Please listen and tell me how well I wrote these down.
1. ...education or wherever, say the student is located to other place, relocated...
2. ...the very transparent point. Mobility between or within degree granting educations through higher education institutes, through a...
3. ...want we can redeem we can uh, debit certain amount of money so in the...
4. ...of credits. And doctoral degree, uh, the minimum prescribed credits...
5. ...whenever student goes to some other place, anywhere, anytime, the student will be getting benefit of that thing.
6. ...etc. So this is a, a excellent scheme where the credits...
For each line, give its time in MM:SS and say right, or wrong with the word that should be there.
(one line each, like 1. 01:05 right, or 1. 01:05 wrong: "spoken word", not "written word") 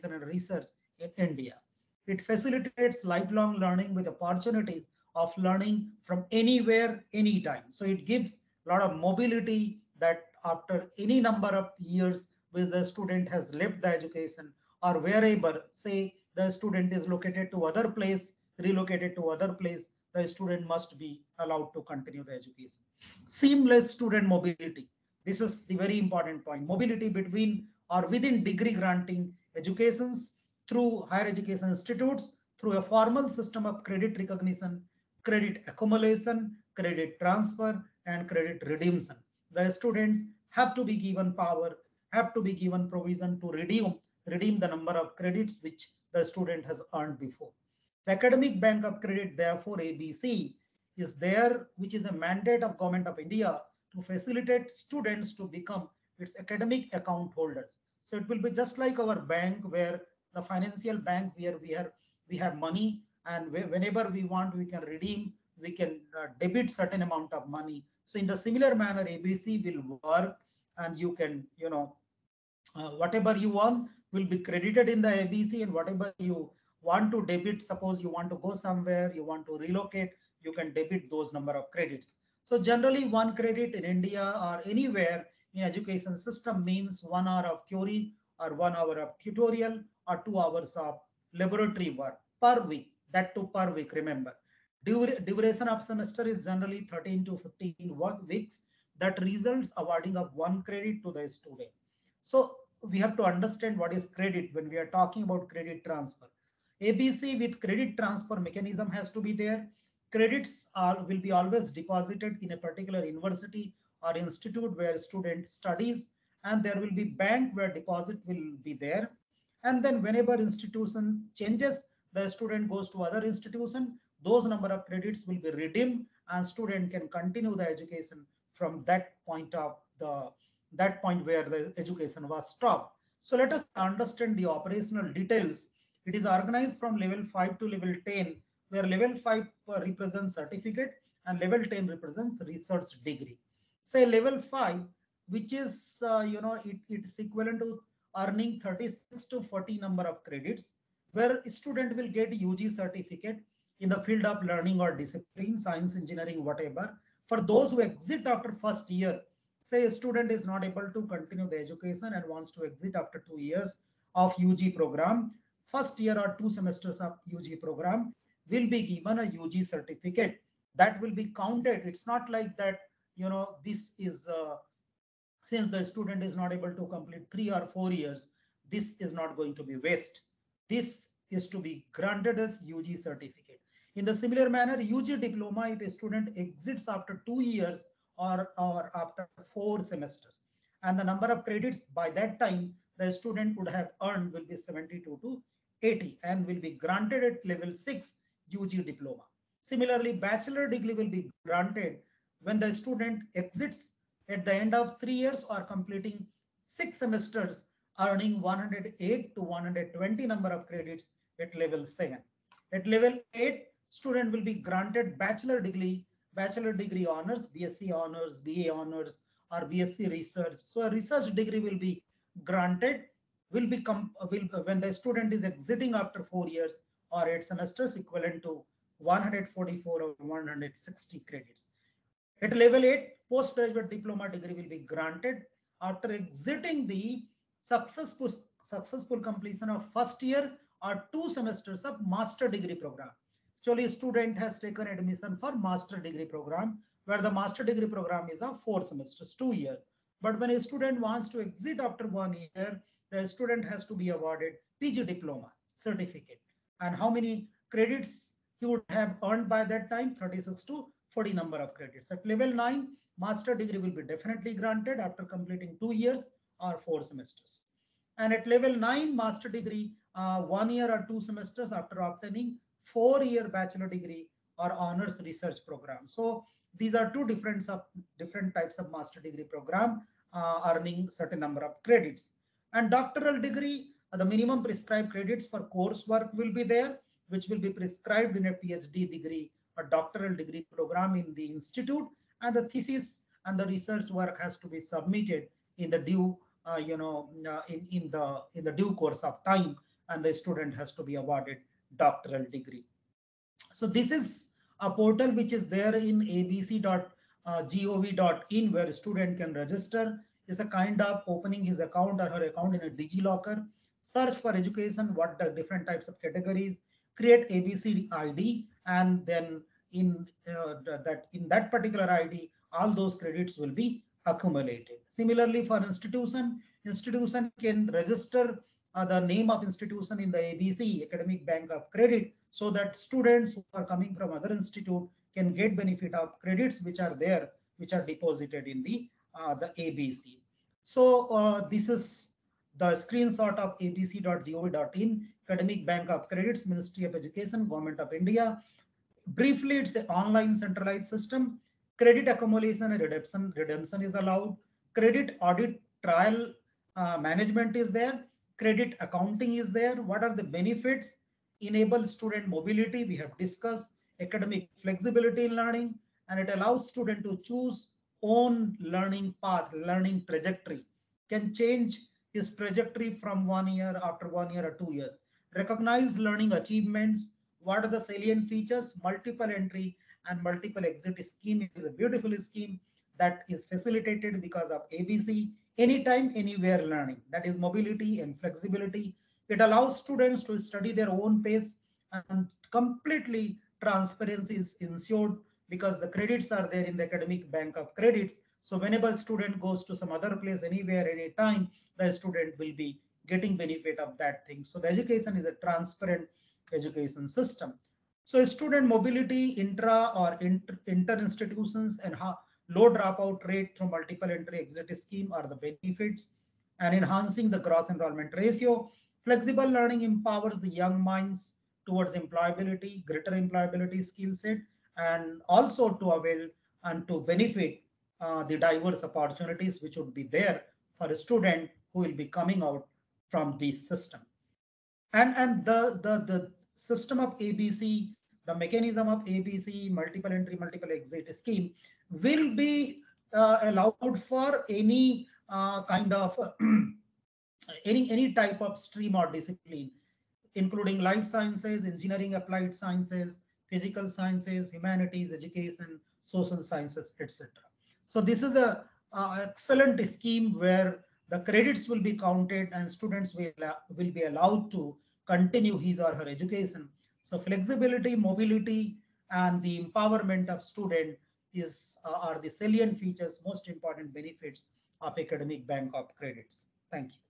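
1. 00:13 right
2. 00:25 wrong: "important", not "transparent"
3. 01:04 right
4. 04:41 right
5. 06:38 right
6. 07:37 right.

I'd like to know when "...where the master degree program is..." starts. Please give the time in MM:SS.
04:07.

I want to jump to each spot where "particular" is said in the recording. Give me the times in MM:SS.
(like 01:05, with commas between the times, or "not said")
01:52, 05:21.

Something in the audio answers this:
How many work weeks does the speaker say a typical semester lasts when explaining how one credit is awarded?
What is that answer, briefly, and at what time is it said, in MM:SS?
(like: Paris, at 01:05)
13 to 15, at 01:36.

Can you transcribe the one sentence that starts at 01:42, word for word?
So we have to understand what is credit when we are talking about credit transfer.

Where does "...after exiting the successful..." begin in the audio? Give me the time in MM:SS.
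03:55.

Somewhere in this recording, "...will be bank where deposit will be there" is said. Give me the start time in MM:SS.
01:56.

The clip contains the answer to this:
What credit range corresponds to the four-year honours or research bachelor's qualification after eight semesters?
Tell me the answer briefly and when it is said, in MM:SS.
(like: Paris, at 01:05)
144 or 160, at 03:48.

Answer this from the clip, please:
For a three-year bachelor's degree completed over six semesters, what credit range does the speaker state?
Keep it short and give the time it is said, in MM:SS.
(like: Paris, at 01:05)
108 to 120, at 03:28.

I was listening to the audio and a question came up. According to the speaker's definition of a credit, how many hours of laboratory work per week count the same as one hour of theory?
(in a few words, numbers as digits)
2 hours.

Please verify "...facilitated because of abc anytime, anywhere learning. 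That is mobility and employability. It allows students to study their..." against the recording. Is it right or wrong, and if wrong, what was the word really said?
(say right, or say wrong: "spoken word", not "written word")
wrong: "flexibility", not "employability".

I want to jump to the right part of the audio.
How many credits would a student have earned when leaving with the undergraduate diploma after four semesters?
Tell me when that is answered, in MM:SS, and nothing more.
03:14.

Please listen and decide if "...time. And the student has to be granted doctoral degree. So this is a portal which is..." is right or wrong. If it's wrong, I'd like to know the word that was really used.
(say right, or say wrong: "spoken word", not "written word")
wrong: "awarded", not "granted".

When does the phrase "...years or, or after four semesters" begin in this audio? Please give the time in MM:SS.
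03:07.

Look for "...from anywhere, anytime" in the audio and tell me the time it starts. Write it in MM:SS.
00:06.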